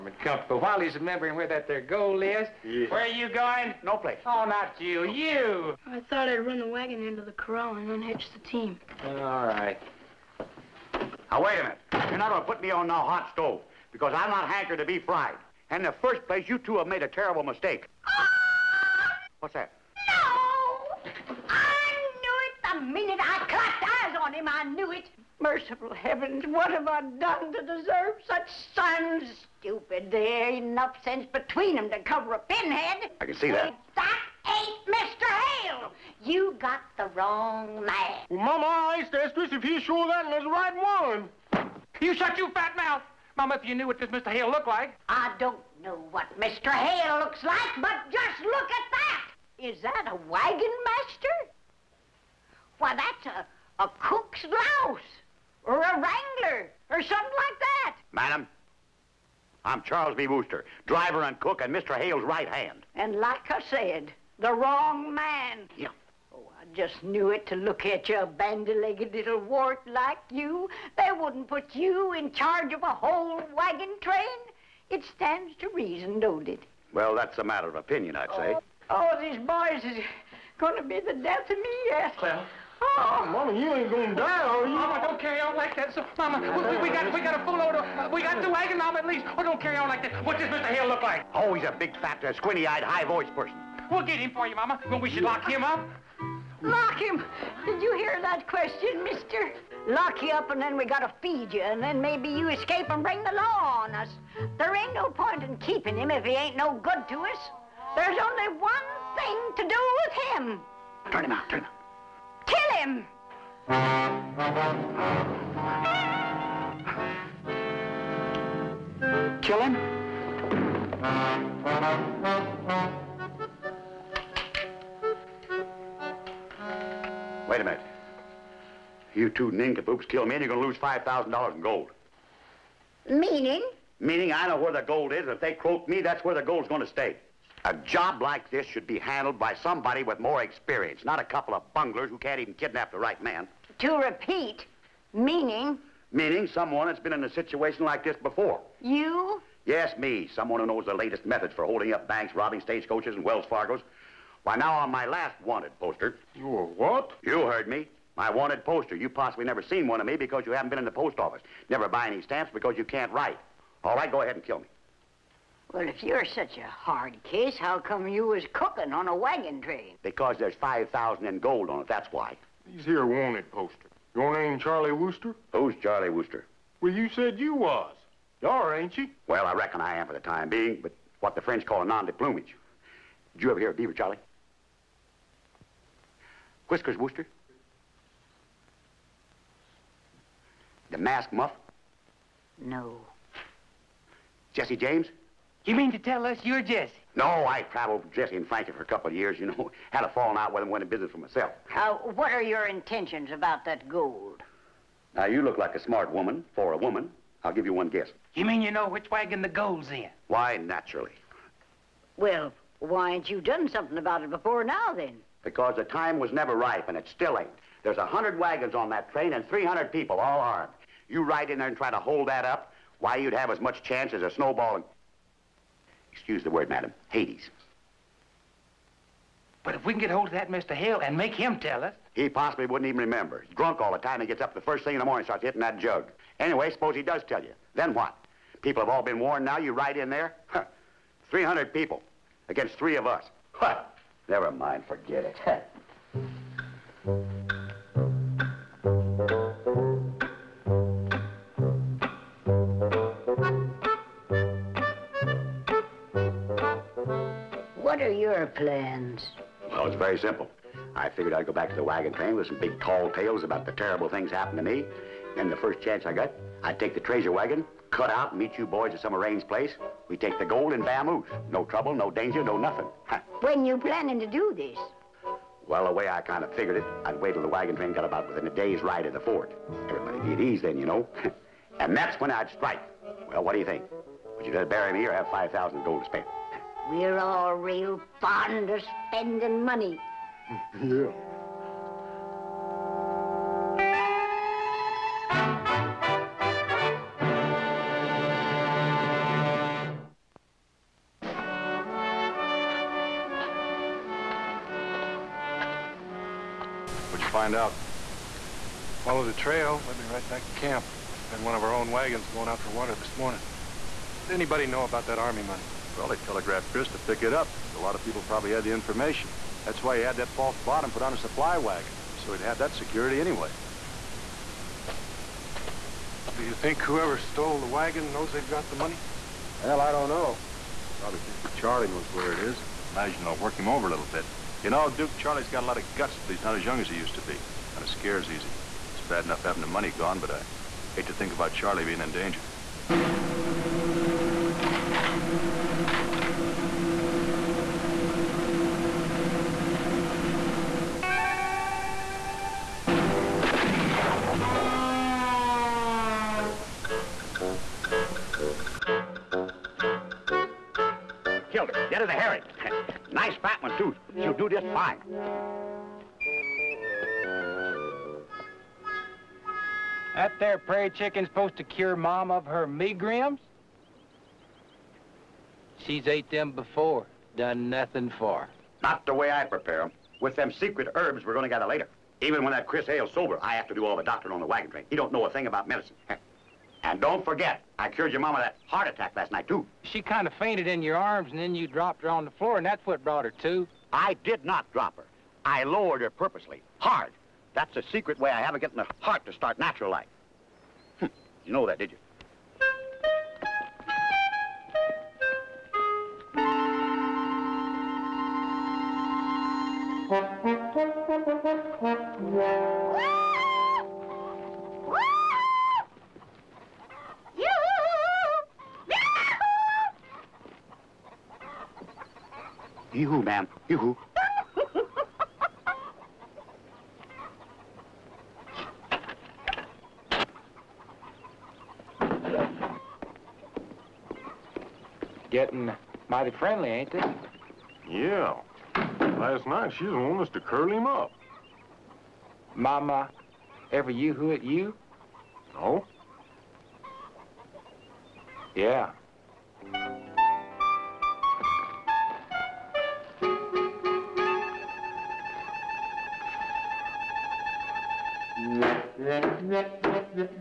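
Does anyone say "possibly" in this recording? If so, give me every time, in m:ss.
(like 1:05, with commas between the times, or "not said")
2:39, 3:52.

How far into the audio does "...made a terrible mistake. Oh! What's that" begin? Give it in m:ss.
0:16.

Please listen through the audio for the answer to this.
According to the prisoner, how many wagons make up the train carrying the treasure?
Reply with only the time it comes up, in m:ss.
3:37.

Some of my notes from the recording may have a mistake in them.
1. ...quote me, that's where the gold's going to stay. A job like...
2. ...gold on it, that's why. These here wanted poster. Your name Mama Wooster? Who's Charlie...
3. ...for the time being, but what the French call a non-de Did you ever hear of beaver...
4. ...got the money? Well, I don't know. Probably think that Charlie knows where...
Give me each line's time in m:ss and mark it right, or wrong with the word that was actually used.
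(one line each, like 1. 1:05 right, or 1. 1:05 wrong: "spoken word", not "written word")
1. 2:15 right
2. 2:51 wrong: "Charlie", not "Mama"
3. 3:00 right
4. 5:28 right.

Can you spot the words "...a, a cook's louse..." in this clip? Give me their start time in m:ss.
0:53.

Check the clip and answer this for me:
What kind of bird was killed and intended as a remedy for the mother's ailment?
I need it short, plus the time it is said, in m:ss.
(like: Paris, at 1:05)
Prairie chicken, at 6:10.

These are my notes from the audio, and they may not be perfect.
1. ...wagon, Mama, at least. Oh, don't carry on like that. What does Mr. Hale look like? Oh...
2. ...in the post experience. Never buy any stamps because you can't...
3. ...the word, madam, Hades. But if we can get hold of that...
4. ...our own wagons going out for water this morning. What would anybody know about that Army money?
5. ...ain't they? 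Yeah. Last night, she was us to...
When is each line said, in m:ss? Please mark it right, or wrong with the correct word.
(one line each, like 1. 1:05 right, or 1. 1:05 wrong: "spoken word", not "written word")
1. 1:28 right
2. 2:40 wrong: "office", not "experience"
3. 3:46 right
4. 5:11 right
5. 7:16 right.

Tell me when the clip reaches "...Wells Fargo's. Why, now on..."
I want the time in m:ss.
2:33.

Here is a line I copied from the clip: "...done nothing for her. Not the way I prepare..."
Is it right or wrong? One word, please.
right.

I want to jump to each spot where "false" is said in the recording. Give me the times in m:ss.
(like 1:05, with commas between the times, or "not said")
5:20.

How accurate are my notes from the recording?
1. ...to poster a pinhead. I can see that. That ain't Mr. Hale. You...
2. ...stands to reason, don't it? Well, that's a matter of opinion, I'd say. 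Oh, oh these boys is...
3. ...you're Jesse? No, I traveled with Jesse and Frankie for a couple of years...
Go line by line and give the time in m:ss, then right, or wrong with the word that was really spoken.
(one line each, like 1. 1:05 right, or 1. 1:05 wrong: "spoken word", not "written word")
1. 0:31 wrong: "cover", not "poster"
2. 1:15 right
3. 3:16 right.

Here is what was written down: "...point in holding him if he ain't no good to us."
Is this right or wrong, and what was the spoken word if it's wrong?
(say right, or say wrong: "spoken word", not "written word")
wrong: "keeping", not "holding".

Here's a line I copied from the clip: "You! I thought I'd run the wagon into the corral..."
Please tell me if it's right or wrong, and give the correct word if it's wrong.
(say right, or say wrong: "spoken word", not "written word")
right.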